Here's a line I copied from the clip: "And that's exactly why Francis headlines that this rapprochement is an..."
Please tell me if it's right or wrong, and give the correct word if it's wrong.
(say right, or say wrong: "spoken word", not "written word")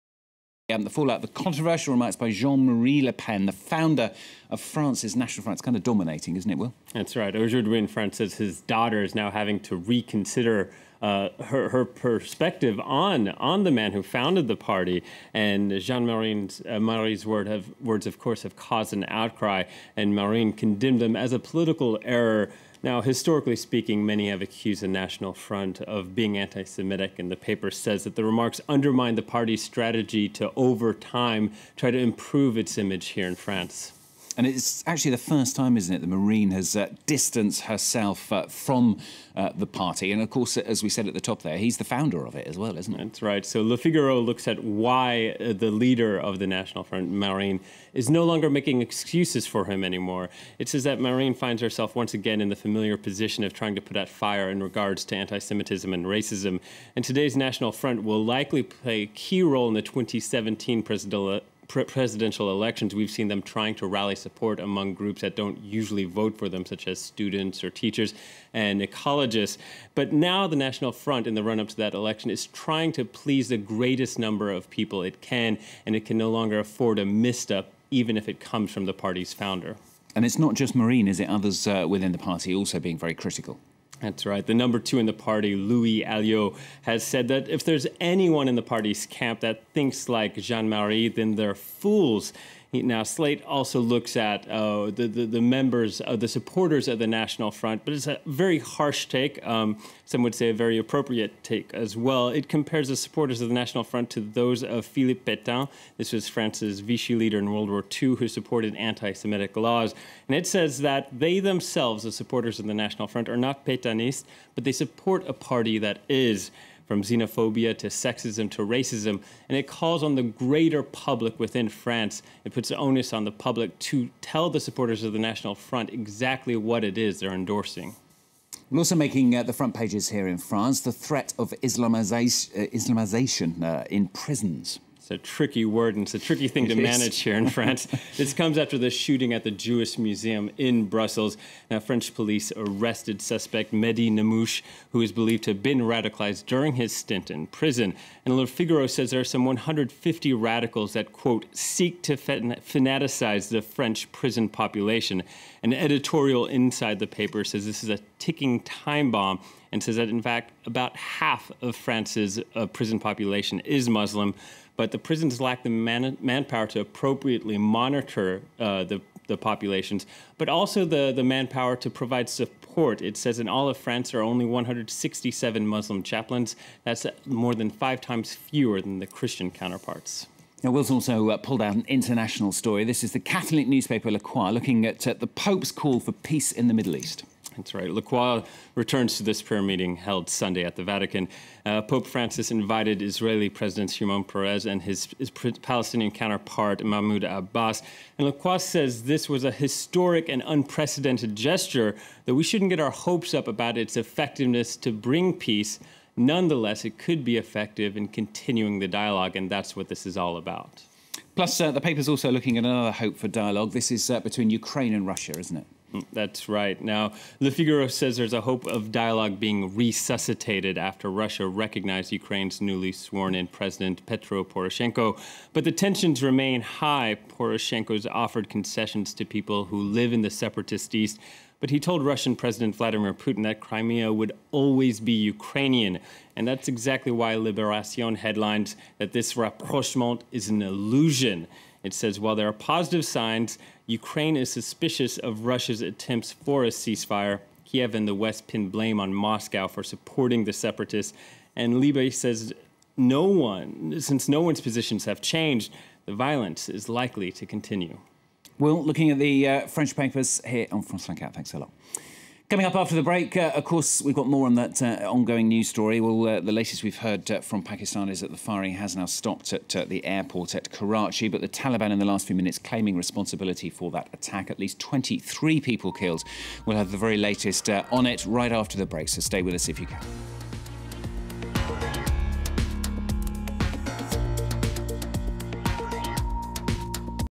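wrong: "Liberation", not "Francis".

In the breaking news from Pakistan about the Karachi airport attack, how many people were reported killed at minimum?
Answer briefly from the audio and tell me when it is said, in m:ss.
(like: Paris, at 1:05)
23, at 4:34.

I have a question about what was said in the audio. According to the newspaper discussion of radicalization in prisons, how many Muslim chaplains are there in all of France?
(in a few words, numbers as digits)
167.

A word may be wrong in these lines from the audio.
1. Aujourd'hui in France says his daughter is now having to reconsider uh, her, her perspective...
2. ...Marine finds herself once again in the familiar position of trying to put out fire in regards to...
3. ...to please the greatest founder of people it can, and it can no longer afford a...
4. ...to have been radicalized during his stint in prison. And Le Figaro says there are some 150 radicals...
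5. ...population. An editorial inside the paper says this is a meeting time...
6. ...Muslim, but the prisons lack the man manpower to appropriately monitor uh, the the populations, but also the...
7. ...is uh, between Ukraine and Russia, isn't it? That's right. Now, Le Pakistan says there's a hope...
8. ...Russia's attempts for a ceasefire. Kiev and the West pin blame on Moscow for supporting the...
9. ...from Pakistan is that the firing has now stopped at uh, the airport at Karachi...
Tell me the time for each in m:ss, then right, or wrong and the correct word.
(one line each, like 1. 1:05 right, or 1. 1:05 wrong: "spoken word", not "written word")
1. 0:07 right
2. 0:50 right
3. 1:12 wrong: "number", not "founder"
4. 2:25 right
5. 2:34 wrong: "ticking", not "meeting"
6. 2:43 right
7. 3:33 wrong: "Figaro", not "Pakistan"
8. 4:05 right
9. 4:27 right.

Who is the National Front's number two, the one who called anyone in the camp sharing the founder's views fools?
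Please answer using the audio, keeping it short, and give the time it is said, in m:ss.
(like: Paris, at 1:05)
Louis Aliot, at 1:25.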